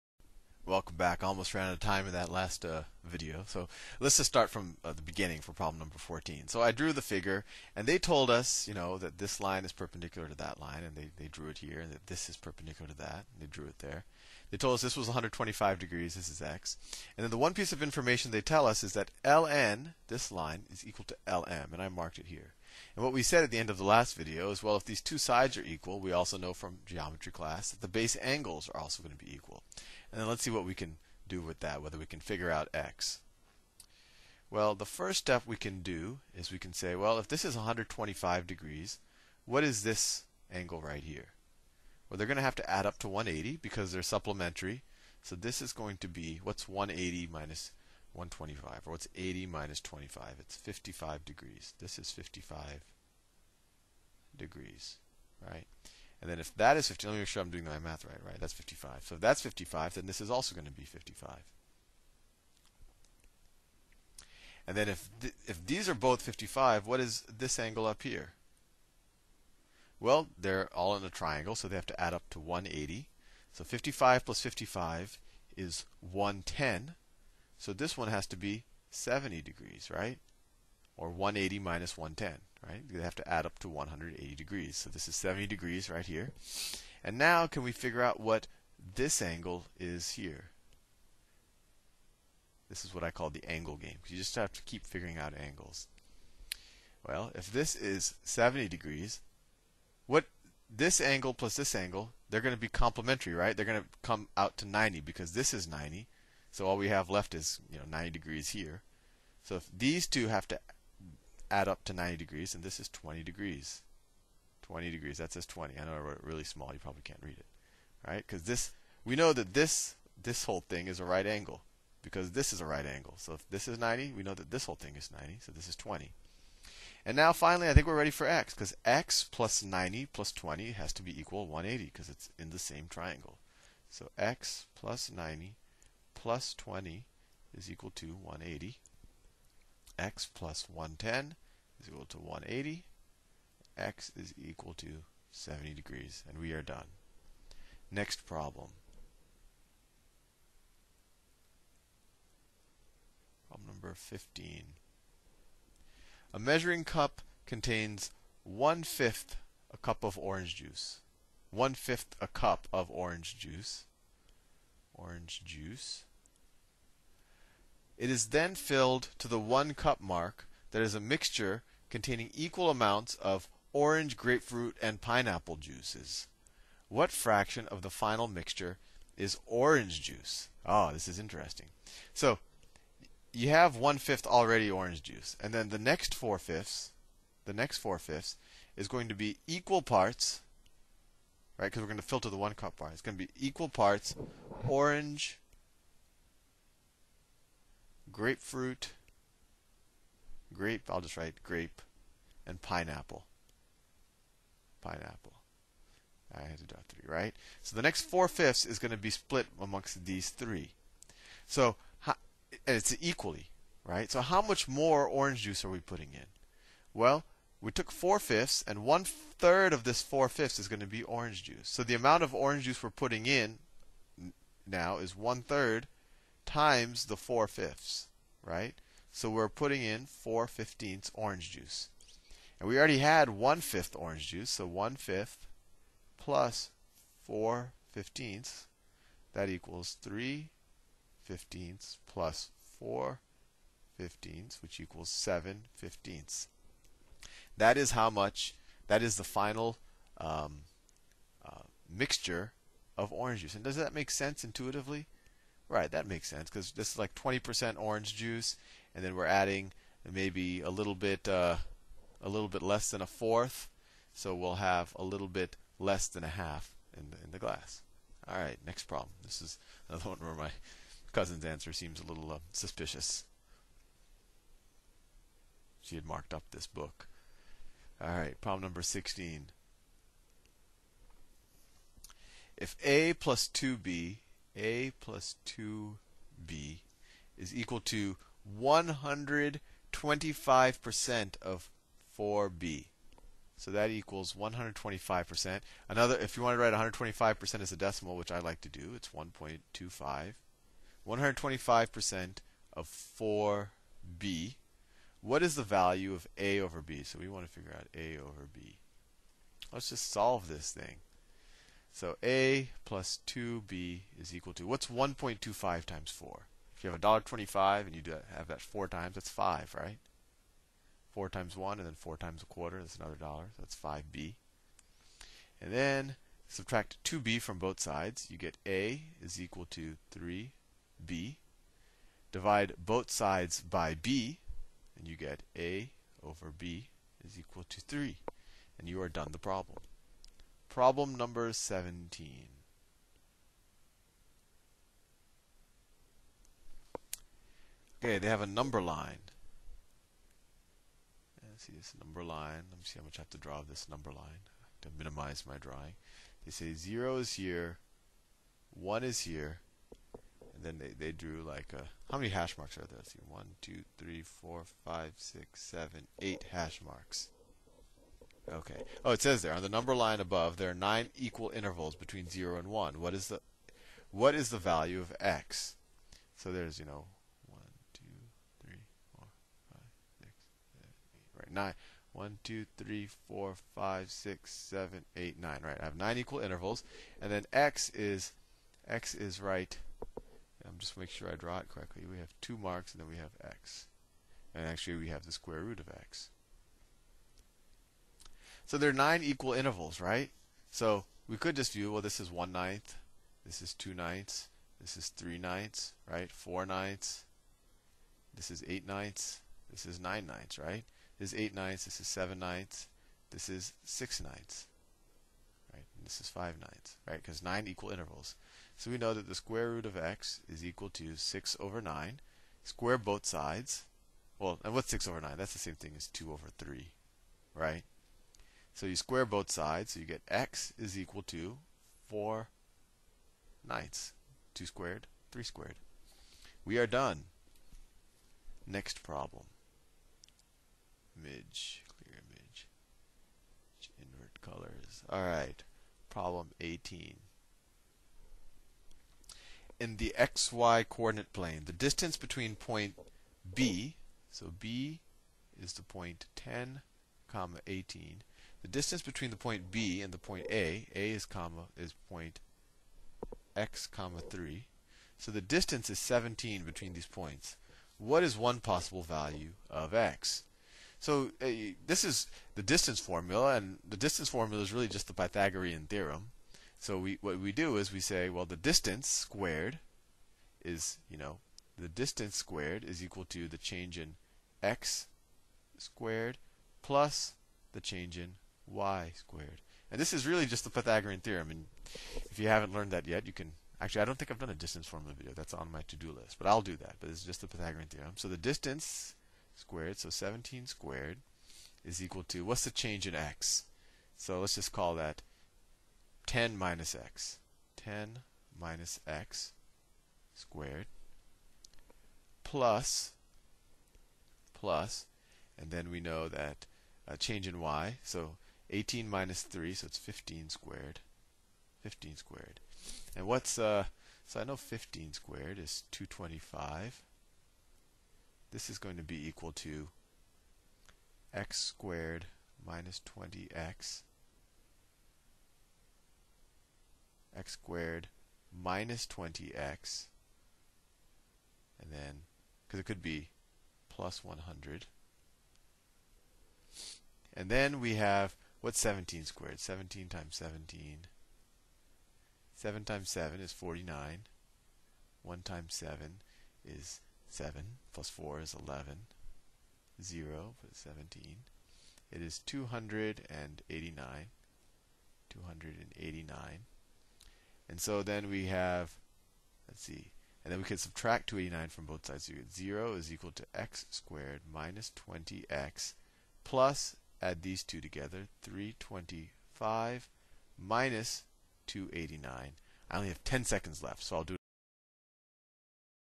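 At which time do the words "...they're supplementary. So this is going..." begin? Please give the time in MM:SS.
00:43.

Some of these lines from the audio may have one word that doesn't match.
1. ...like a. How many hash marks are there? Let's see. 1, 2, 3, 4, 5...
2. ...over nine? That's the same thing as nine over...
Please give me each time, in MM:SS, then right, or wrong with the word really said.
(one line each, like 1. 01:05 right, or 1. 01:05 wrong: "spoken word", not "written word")
1. 06:01 right
2. 07:05 wrong: "two", not "nine".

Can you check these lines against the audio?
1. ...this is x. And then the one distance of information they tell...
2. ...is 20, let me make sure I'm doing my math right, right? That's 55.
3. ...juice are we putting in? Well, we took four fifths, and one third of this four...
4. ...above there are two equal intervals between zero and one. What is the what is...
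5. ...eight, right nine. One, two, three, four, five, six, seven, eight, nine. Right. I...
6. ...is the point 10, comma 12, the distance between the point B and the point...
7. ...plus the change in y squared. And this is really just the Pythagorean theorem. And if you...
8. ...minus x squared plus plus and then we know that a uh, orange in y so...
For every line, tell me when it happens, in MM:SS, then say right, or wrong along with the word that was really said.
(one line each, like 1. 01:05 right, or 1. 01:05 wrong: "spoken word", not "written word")
1. 00:16 wrong: "piece", not "distance"
2. 00:56 wrong: "50", not "20"
3. 03:35 right
4. 06:10 wrong: "nine", not "two"
5. 06:20 right
6. 07:35 wrong: "18", not "12"
7. 08:06 right
8. 08:28 wrong: "change", not "orange".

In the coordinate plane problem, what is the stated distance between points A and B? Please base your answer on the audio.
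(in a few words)
17.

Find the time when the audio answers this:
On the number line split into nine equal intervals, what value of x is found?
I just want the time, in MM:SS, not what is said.
07:10.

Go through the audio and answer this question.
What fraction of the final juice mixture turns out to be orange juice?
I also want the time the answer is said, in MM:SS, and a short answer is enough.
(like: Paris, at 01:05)
7/15, at 04:05.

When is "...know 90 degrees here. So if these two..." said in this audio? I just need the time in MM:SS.
01:47.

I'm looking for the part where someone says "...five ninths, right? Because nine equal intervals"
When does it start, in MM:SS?
06:56.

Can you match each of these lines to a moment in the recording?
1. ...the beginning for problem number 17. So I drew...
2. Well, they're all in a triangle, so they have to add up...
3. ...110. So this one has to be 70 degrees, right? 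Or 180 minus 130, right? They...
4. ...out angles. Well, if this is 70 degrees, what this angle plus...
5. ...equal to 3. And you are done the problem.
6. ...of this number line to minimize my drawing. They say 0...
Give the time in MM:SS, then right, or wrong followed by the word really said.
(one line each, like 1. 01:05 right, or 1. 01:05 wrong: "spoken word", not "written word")
1. 00:04 wrong: "14", not "17"
2. 01:09 right
3. 01:15 wrong: "110", not "130"
4. 01:35 right
5. 05:37 right
6. 05:53 right.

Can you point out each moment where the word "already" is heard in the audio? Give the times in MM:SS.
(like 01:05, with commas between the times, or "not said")
03:04, 03:52.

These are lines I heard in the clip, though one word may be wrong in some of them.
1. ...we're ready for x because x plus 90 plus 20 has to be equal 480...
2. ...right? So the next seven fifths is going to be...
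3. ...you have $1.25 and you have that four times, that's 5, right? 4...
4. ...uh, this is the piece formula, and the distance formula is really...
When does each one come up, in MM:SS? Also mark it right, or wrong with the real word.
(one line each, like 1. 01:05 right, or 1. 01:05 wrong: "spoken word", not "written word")
1. 02:07 wrong: "180", not "480"
2. 03:27 wrong: "four", not "seven"
3. 05:16 right
4. 07:51 wrong: "distance", not "piece".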